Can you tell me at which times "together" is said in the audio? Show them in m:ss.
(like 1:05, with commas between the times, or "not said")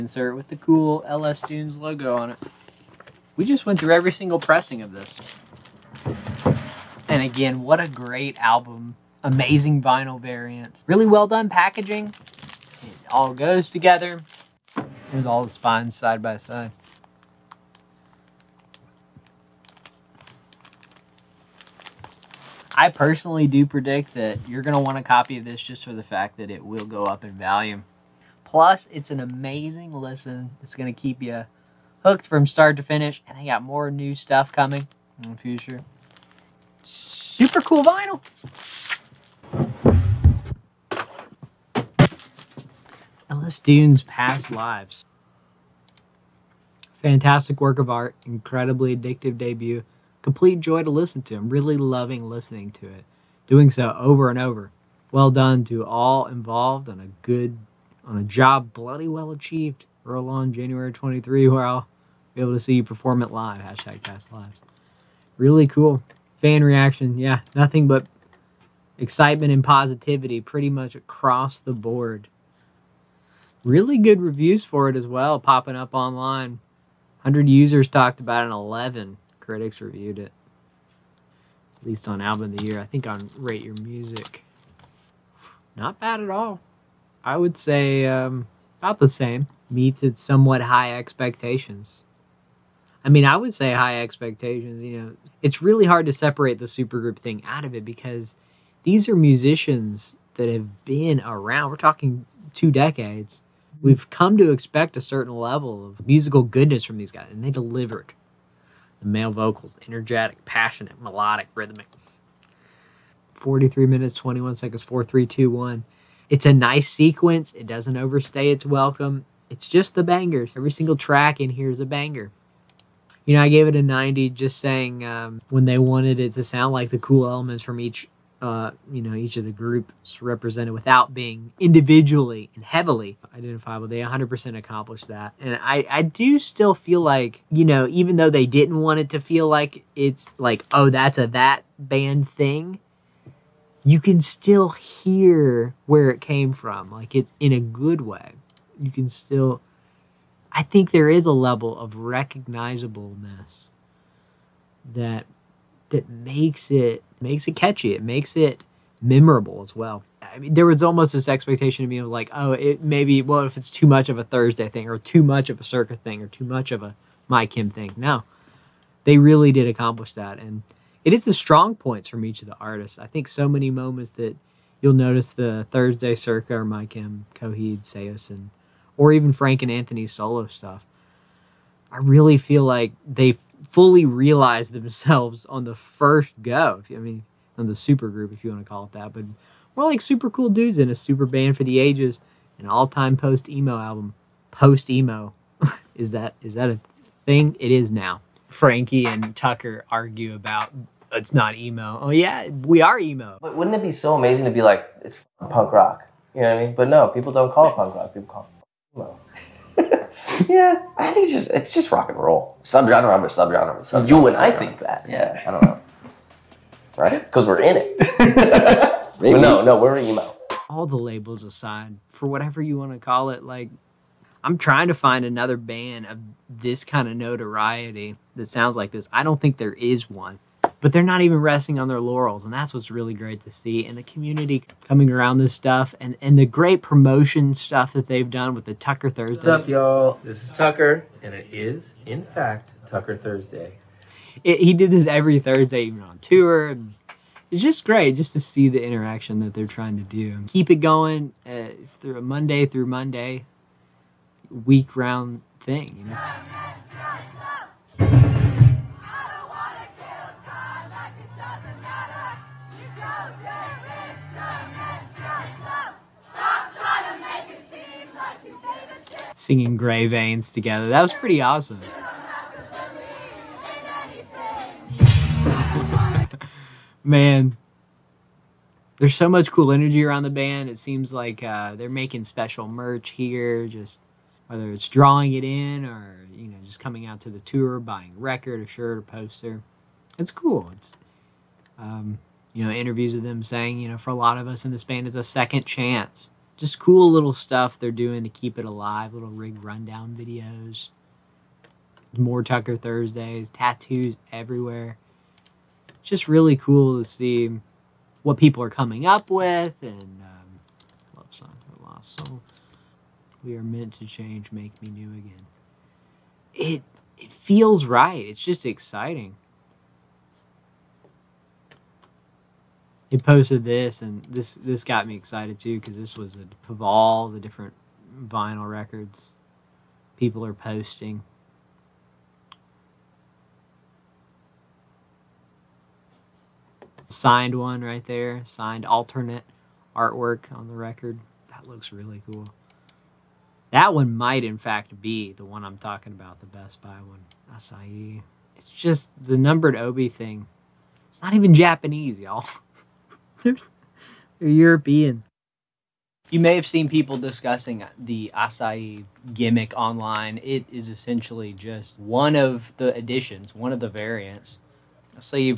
0:13, 4:30.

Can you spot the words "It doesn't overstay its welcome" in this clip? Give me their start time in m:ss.
1:57.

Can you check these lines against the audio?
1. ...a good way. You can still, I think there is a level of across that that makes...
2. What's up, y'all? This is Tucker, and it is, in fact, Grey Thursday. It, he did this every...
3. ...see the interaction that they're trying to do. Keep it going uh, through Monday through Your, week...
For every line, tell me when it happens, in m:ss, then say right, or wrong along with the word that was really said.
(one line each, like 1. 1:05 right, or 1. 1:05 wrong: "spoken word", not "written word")
1. 2:27 wrong: "recognizableness", not "across"
2. 3:59 wrong: "Tucker", not "Grey"
3. 4:08 wrong: "Monday", not "Your".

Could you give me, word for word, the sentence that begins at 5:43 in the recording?
That one might, in fact, be the one I'm talking about, the Best Buy one.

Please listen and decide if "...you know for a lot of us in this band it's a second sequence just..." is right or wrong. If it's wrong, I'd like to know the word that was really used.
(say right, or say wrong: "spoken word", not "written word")
wrong: "chance", not "sequence".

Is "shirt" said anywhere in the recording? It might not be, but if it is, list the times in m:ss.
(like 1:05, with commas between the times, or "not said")
4:48.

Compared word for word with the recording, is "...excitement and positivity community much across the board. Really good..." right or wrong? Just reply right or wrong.
wrong.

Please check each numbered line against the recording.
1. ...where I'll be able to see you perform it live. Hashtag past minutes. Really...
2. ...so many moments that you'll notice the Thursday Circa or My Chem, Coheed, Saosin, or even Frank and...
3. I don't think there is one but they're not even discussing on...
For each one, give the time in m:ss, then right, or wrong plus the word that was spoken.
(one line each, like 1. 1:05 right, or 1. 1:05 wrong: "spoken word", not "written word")
1. 1:01 wrong: "lives", not "minutes"
2. 2:53 right
3. 3:49 wrong: "resting", not "discussing".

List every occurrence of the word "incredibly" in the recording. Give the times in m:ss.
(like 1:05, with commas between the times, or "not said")
0:48.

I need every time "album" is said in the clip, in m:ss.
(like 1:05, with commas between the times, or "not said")
0:08, 1:22, 3:13.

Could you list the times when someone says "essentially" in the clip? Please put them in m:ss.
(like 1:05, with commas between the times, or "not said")
6:00.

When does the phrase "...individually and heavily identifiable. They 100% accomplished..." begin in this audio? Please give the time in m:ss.
2:11.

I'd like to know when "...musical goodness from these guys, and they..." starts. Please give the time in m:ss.
1:46.